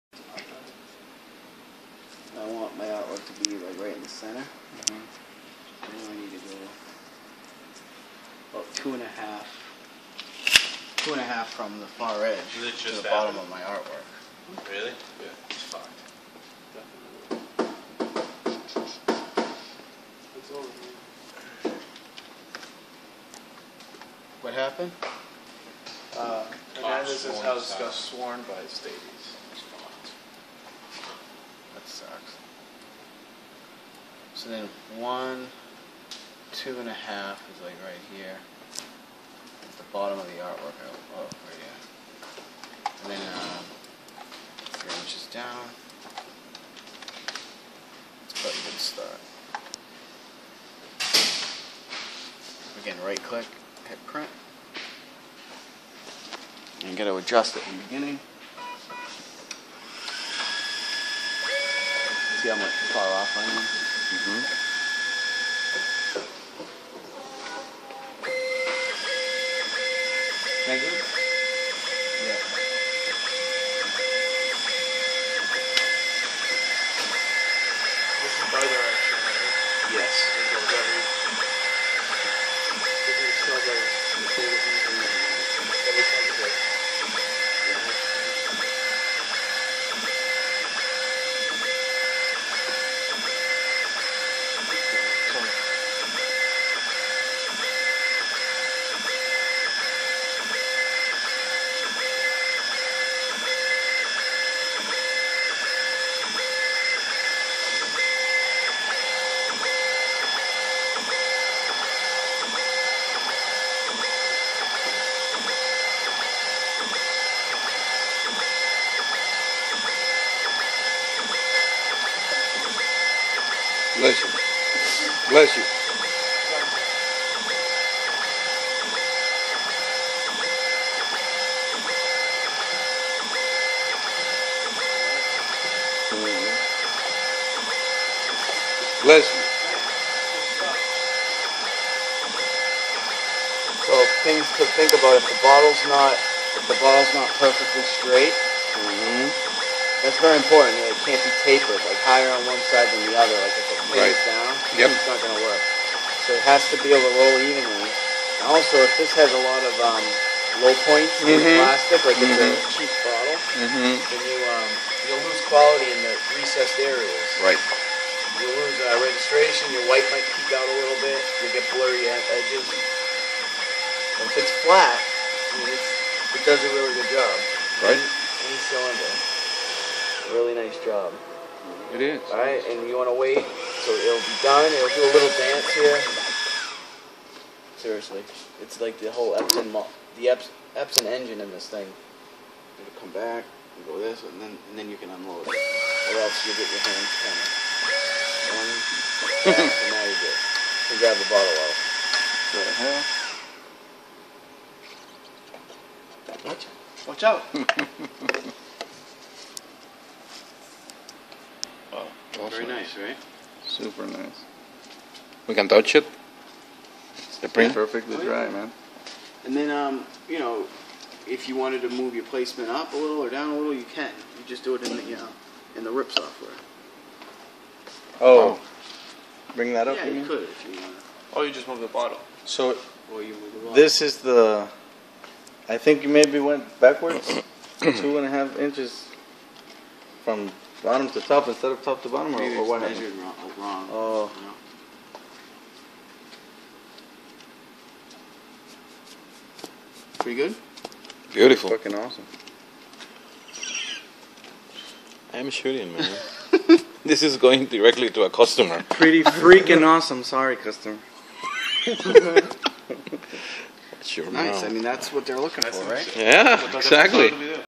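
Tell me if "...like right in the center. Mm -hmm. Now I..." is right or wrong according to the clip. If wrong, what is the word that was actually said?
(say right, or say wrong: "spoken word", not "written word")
right.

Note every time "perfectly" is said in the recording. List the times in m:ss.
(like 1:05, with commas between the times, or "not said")
2:27, 3:37.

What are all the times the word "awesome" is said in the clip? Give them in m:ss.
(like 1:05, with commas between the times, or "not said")
4:11, 4:19.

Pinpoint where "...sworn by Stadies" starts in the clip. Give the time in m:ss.
0:27.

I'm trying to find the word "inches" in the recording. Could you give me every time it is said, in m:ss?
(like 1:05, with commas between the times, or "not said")
0:44, 3:58.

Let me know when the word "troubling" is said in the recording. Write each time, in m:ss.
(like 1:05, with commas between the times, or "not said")
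not said.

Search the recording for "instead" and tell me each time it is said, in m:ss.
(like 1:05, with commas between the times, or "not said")
4:01.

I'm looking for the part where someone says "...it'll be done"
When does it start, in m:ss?
3:03.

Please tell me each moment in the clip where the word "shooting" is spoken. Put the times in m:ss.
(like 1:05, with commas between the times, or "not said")
4:15.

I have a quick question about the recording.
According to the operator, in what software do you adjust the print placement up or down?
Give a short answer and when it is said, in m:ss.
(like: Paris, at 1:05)
RIP software, at 3:45.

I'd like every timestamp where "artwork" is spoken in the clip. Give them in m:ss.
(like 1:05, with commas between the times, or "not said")
0:13, 0:40.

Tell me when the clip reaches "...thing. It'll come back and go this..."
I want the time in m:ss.
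3:11.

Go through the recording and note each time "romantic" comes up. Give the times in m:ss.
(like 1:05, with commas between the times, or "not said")
not said.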